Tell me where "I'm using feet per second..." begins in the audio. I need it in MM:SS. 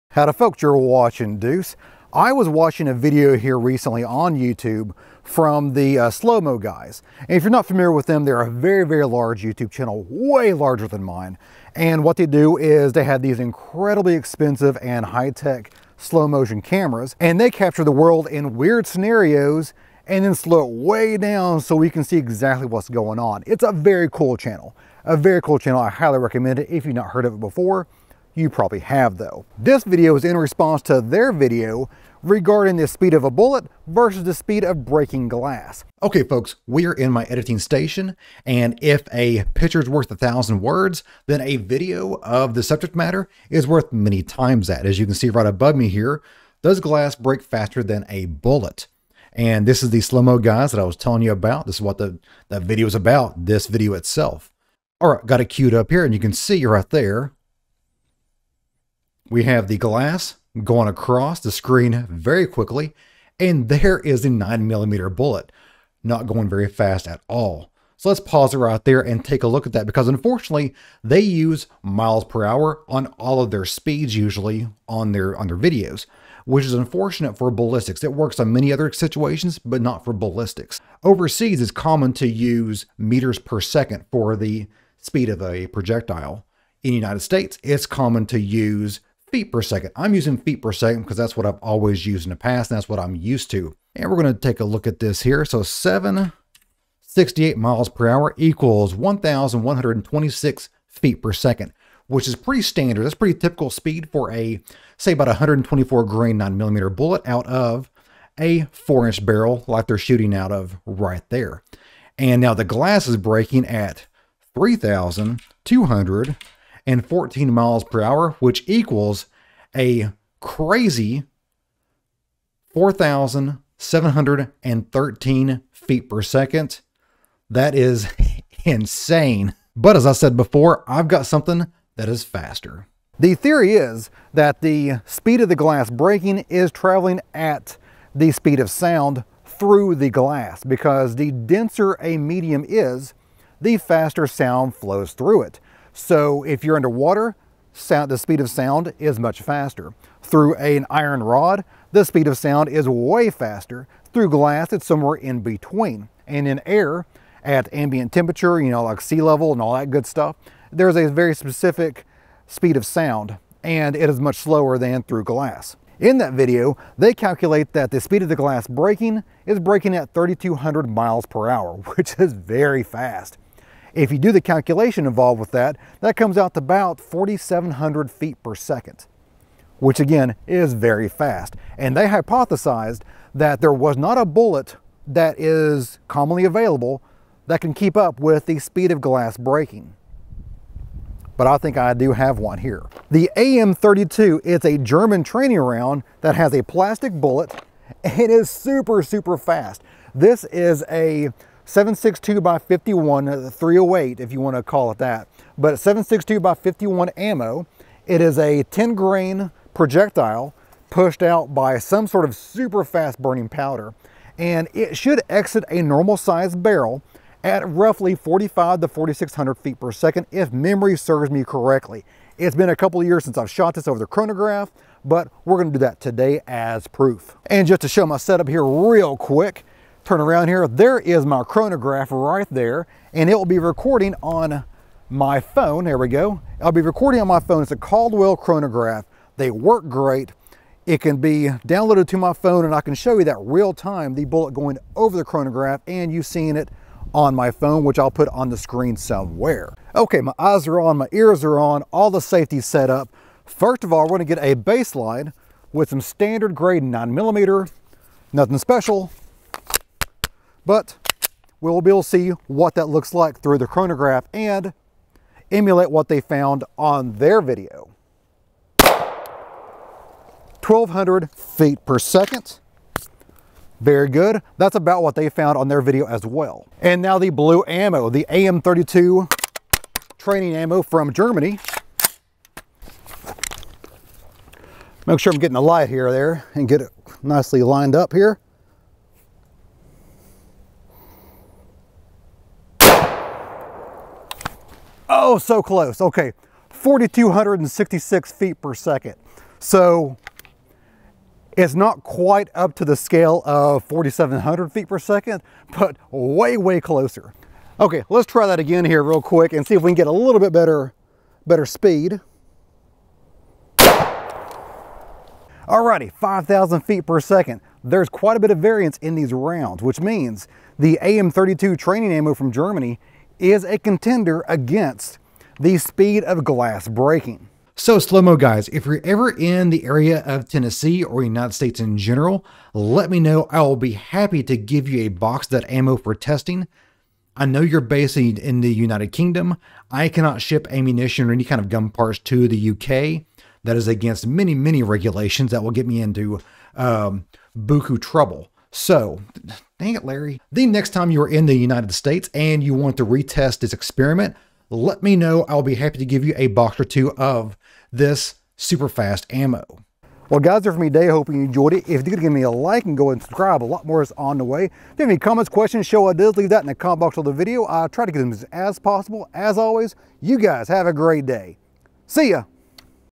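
01:29.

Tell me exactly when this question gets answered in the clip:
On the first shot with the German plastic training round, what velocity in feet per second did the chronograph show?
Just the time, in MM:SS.
04:56.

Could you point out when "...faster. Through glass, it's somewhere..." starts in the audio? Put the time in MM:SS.
02:33.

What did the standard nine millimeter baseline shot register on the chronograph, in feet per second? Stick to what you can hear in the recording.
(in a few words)
1200.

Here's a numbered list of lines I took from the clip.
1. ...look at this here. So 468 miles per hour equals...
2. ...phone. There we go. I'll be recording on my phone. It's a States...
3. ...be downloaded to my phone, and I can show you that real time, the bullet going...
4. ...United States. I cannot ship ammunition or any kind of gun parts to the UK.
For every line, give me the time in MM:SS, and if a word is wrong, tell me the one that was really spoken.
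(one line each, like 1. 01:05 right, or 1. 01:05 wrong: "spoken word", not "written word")
1. 01:34 wrong: "768", not "468"
2. 03:55 wrong: "Caldwell", not "States"
3. 04:01 right
4. 05:38 wrong: "Kingdom", not "States".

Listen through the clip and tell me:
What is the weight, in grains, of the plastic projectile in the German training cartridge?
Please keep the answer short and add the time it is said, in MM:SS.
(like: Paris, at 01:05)
10 grain, at 03:28.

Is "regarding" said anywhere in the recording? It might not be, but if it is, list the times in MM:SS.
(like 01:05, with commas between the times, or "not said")
00:32.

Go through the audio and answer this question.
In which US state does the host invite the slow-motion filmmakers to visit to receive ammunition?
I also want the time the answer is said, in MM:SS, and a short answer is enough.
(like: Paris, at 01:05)
Tennessee, at 05:30.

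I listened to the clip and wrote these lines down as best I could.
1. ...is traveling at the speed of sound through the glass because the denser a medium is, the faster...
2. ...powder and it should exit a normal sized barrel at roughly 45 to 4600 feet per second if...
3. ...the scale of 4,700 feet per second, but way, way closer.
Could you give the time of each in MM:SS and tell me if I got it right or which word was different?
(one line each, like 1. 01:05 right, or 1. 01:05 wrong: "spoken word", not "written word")
1. 02:16 right
2. 03:33 right
3. 05:02 right.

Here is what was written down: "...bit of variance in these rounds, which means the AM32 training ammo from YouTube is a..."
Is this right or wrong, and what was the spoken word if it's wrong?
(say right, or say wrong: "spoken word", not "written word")
wrong: "Germany", not "YouTube".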